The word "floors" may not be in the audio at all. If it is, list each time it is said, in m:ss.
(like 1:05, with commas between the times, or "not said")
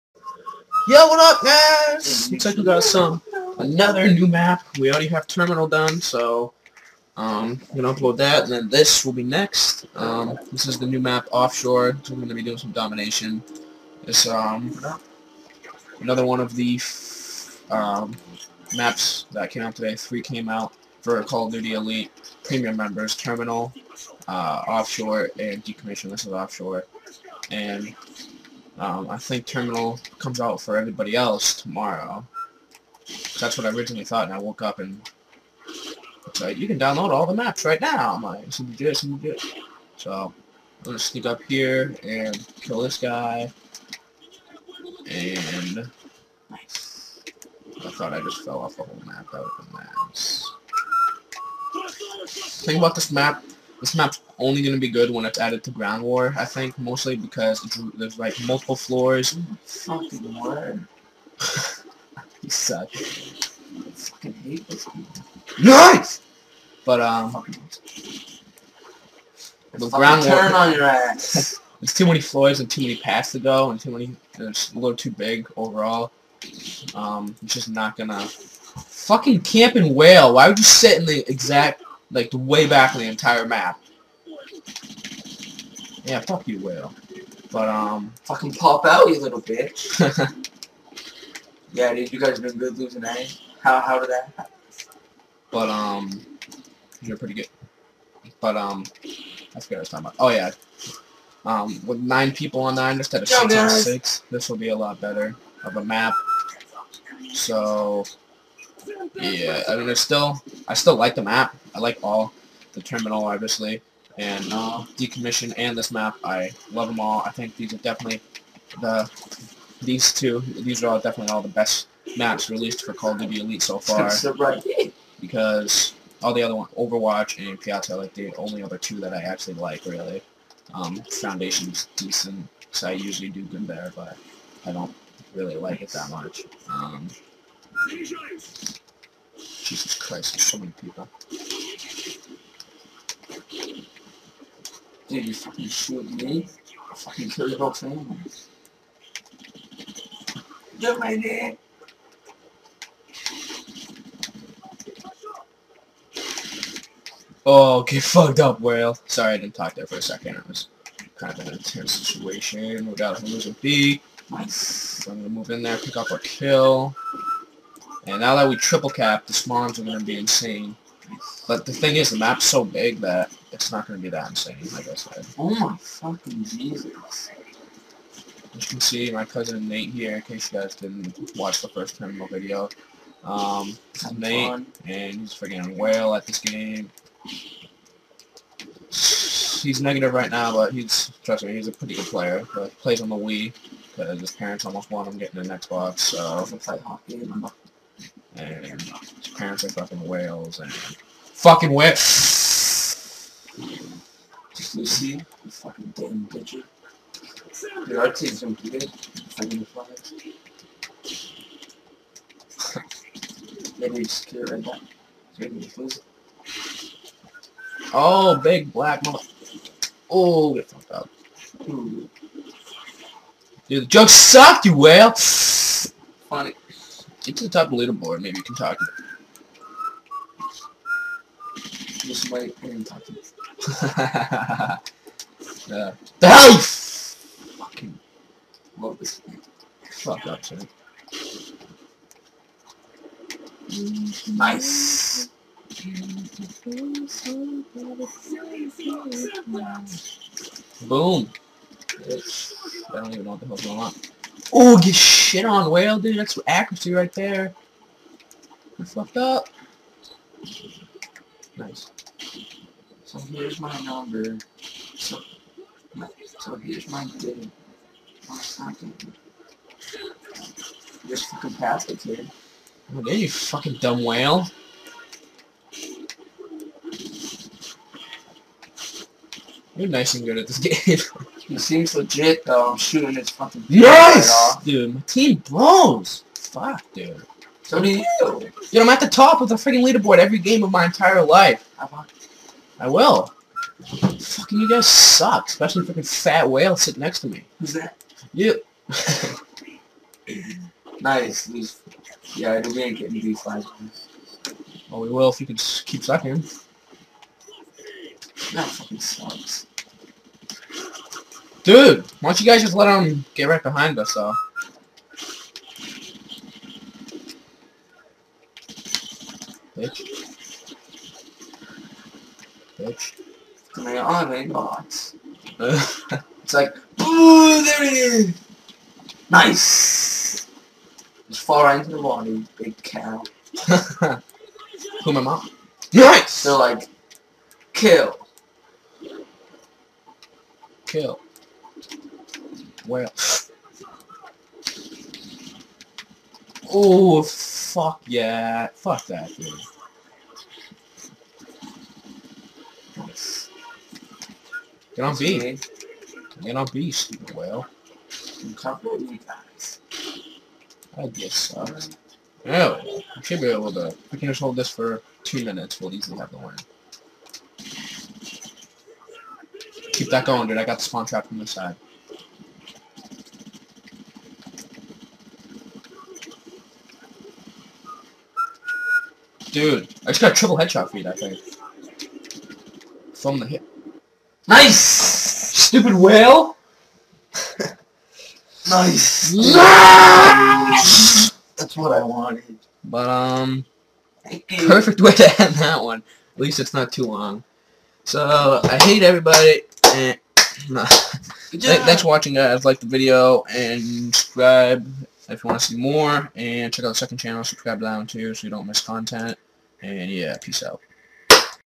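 0:58, 1:12.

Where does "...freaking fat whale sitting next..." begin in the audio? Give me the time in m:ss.
4:55.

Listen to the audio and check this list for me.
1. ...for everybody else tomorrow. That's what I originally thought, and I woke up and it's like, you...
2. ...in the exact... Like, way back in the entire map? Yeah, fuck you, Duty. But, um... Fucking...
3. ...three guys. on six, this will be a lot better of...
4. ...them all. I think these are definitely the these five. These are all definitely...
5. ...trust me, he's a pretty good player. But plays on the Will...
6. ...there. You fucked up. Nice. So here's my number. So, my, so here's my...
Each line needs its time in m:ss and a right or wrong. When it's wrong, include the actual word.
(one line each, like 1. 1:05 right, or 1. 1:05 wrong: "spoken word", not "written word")
1. 0:30 right
2. 1:20 wrong: "Will", not "Duty"
3. 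1:43 wrong: "six", not "three"
4. 1:56 wrong: "two", not "five"
5. 3:11 wrong: "Wii", not "Will"
6. 4:17 right.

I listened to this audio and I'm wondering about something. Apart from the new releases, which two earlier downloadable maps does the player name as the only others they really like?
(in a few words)
Overwatch and Piazza.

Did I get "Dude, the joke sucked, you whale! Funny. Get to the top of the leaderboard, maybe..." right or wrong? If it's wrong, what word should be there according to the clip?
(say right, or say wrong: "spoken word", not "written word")
right.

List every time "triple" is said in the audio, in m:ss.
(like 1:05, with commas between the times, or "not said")
2:48, 6:20.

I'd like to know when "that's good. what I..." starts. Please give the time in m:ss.
1:39.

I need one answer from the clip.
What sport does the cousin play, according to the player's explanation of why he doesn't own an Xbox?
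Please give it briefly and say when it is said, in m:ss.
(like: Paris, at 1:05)
hockey, at 3:16.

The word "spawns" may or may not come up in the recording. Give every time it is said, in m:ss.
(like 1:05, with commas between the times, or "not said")
2:49, 6:10.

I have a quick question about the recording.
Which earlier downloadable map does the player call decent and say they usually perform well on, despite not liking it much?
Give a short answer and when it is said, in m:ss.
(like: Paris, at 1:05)
Foundation, at 2:11.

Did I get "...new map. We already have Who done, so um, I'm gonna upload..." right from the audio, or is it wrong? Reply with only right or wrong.
wrong.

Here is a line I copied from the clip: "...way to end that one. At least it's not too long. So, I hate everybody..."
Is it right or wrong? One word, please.
right.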